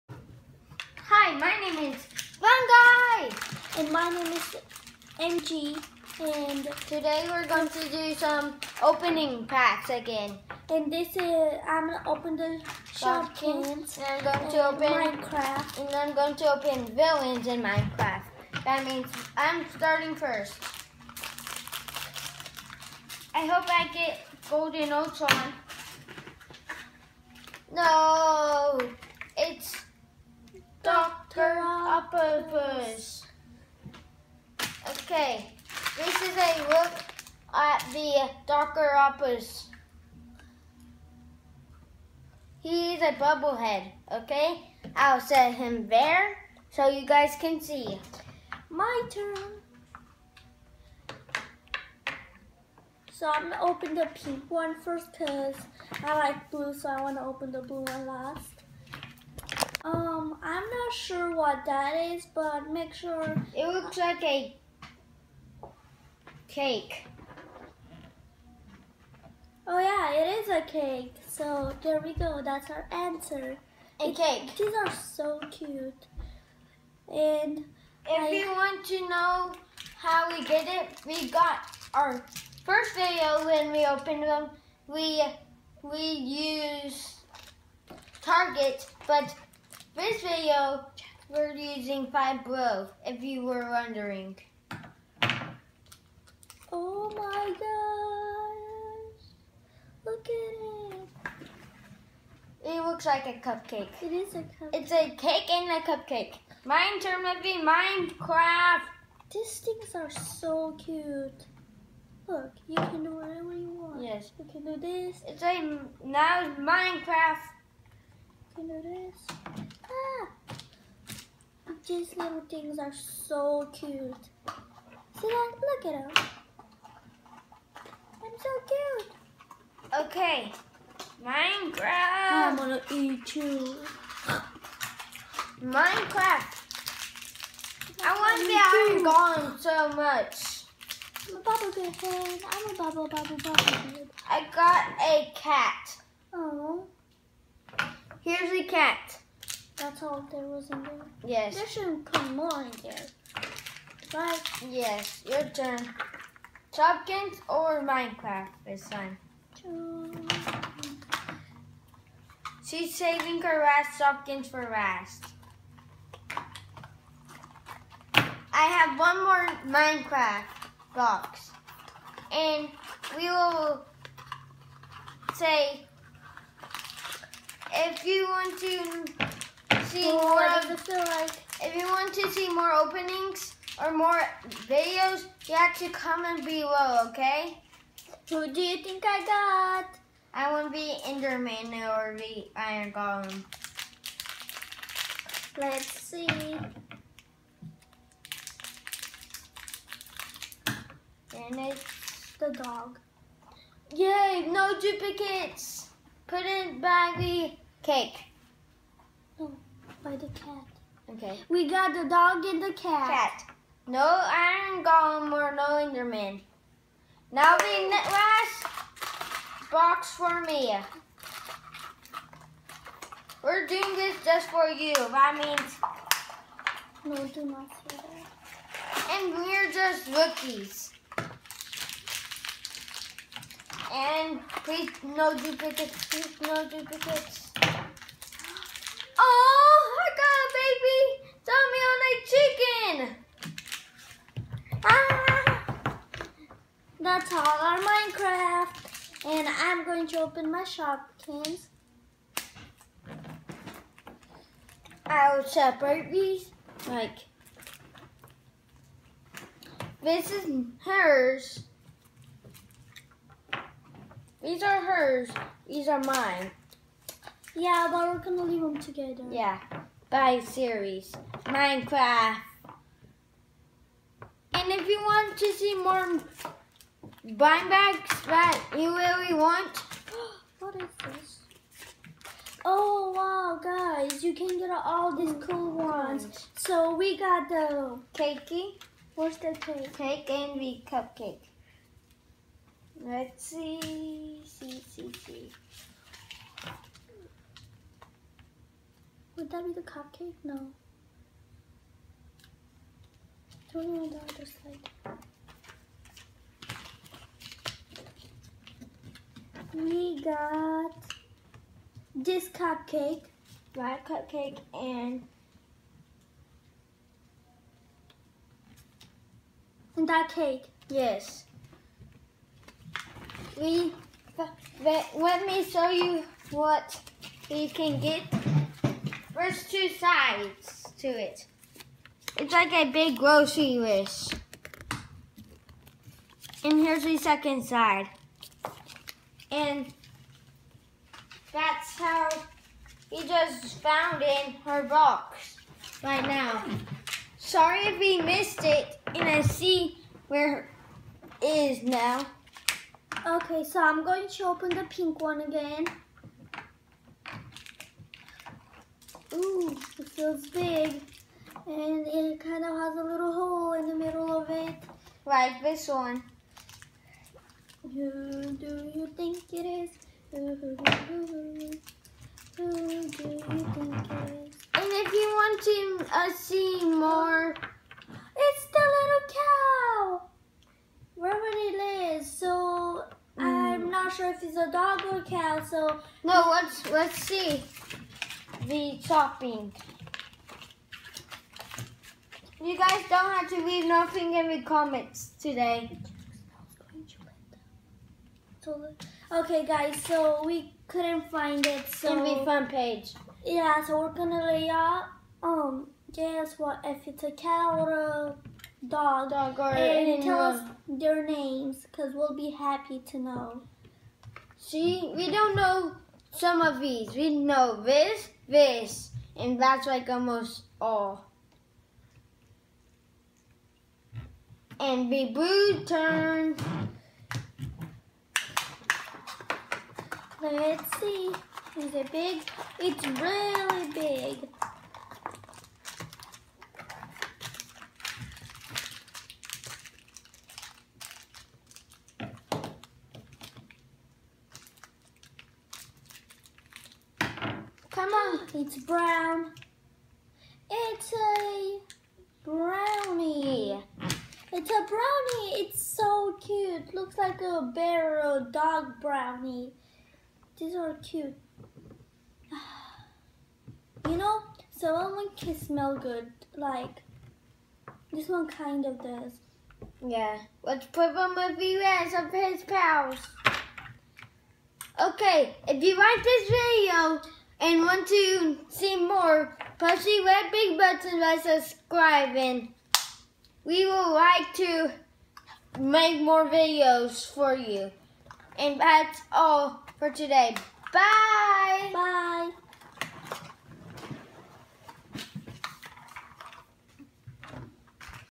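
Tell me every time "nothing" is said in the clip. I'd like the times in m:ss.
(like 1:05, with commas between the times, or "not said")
6:33.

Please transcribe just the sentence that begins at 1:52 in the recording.
Look, you can do whatever you want.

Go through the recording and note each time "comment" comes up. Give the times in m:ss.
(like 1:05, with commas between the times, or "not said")
3:05, 6:34.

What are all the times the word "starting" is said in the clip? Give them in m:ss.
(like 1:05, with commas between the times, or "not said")
0:19.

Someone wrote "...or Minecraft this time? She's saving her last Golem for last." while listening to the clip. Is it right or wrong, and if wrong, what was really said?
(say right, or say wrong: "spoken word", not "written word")
wrong: "Shopkins", not "Golem".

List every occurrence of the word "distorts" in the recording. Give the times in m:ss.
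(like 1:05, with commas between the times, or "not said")
not said.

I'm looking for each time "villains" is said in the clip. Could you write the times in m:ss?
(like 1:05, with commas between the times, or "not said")
0:16.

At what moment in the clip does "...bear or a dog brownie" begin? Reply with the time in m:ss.
7:37.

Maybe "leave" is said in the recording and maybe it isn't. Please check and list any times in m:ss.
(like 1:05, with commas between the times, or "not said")
4:28, 6:33.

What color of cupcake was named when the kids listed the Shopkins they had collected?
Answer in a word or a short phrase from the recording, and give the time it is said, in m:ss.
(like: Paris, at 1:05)
Black, at 5:13.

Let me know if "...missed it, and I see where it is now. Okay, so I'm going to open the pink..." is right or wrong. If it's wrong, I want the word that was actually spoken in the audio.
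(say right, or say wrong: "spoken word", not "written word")
right.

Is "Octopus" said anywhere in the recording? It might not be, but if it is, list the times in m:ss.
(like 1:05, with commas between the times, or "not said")
0:31, 0:38.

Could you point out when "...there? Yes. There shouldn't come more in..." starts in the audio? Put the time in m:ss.
2:30.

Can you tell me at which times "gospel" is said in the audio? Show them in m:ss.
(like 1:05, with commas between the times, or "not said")
not said.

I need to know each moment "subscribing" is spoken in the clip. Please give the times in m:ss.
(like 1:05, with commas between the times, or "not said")
8:01.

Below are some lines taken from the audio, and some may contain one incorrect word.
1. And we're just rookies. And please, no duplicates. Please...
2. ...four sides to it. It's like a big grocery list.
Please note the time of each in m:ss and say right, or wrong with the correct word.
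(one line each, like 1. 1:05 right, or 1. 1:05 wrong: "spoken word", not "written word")
1. 3:49 right
2. 5:29 wrong: "two", not "four".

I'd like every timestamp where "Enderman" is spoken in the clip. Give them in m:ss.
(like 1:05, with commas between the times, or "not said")
3:11, 3:35.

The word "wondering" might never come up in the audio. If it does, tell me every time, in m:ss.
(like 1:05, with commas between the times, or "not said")
1:33.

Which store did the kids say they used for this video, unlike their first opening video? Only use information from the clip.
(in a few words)
Fibro.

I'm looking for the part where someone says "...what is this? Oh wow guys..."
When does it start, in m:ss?
4:40.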